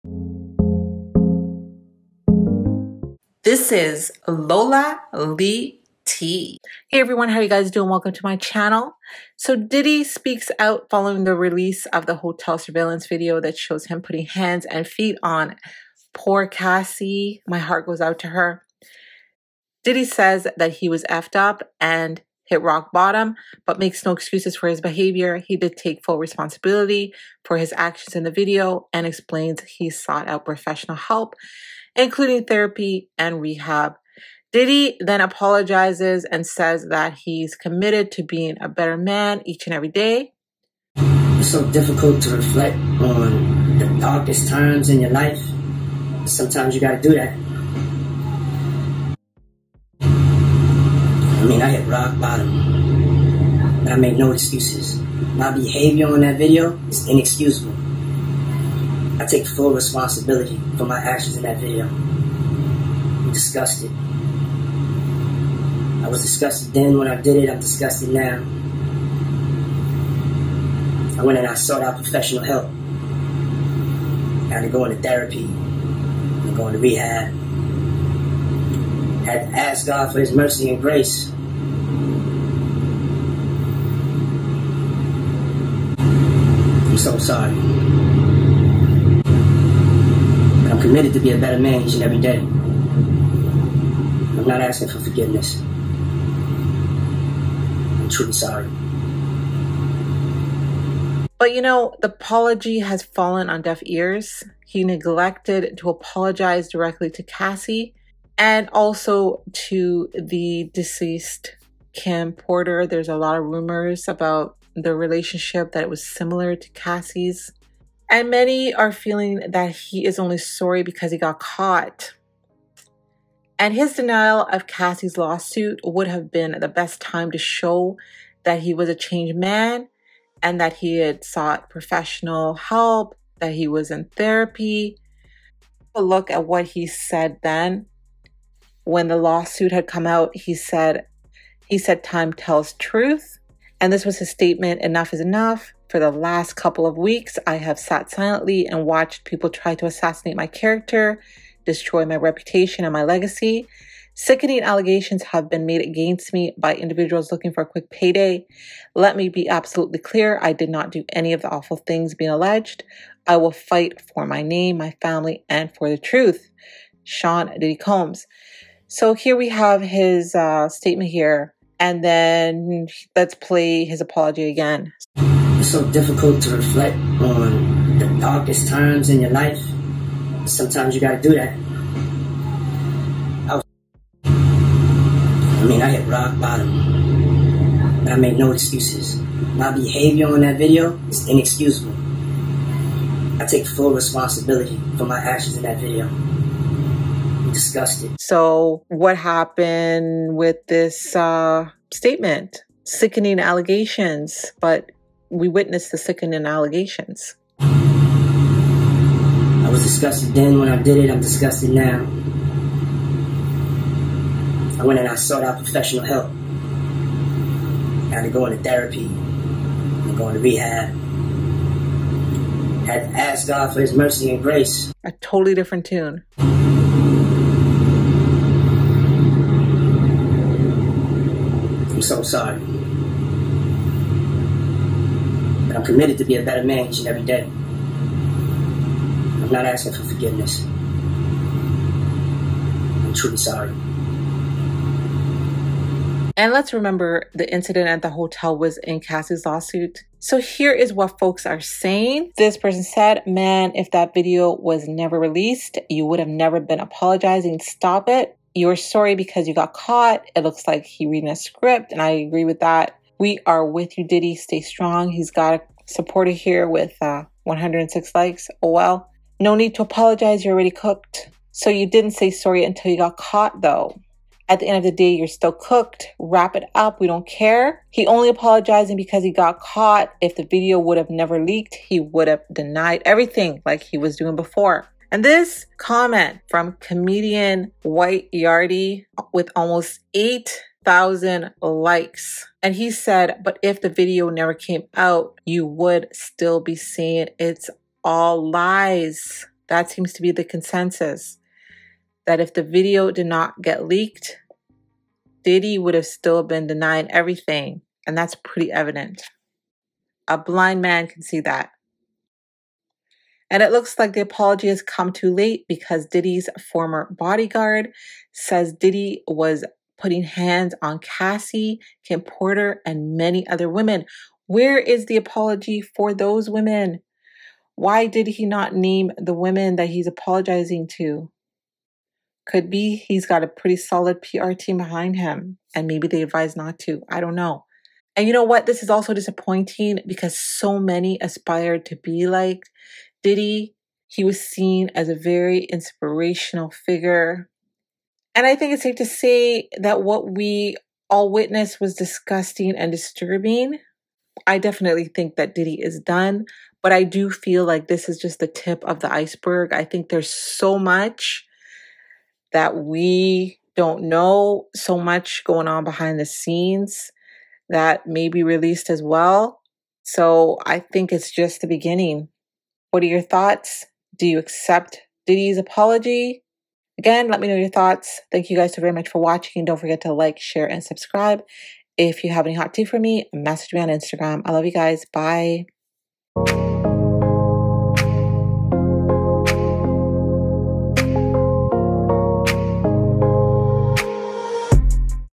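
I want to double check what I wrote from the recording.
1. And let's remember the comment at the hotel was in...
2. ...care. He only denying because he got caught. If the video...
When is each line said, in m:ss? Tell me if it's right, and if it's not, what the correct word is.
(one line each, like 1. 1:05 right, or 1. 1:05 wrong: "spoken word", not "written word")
1. 4:06 wrong: "incident", not "comment"
2. 4:37 wrong: "apologizing", not "denying".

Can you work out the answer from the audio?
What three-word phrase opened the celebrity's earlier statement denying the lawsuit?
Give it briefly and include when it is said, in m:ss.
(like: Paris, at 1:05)
Time tells truth, at 2:22.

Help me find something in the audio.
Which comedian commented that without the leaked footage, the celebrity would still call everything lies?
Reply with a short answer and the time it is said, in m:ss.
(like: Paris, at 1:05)
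White Yardy, at 4:47.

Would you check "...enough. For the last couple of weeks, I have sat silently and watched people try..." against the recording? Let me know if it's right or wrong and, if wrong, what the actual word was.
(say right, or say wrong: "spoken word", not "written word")
right.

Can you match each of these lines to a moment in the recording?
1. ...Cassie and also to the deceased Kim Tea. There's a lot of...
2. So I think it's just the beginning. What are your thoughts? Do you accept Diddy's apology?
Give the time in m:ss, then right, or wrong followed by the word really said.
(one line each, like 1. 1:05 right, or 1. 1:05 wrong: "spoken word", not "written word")
1. 1:47 wrong: "Porter", not "Tea"
2. 6:10 right.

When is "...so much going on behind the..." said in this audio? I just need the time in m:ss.
6:04.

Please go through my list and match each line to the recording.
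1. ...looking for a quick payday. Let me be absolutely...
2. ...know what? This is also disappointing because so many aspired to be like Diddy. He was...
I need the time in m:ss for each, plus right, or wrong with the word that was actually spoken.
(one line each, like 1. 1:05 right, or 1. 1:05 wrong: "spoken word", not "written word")
1. 2:37 right
2. 5:38 right.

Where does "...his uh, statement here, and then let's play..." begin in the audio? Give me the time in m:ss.
2:49.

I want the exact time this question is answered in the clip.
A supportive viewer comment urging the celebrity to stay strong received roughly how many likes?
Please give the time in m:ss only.
4:27.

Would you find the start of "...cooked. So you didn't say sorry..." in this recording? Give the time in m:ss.
4:30.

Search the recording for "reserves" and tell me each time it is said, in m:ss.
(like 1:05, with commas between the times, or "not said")
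not said.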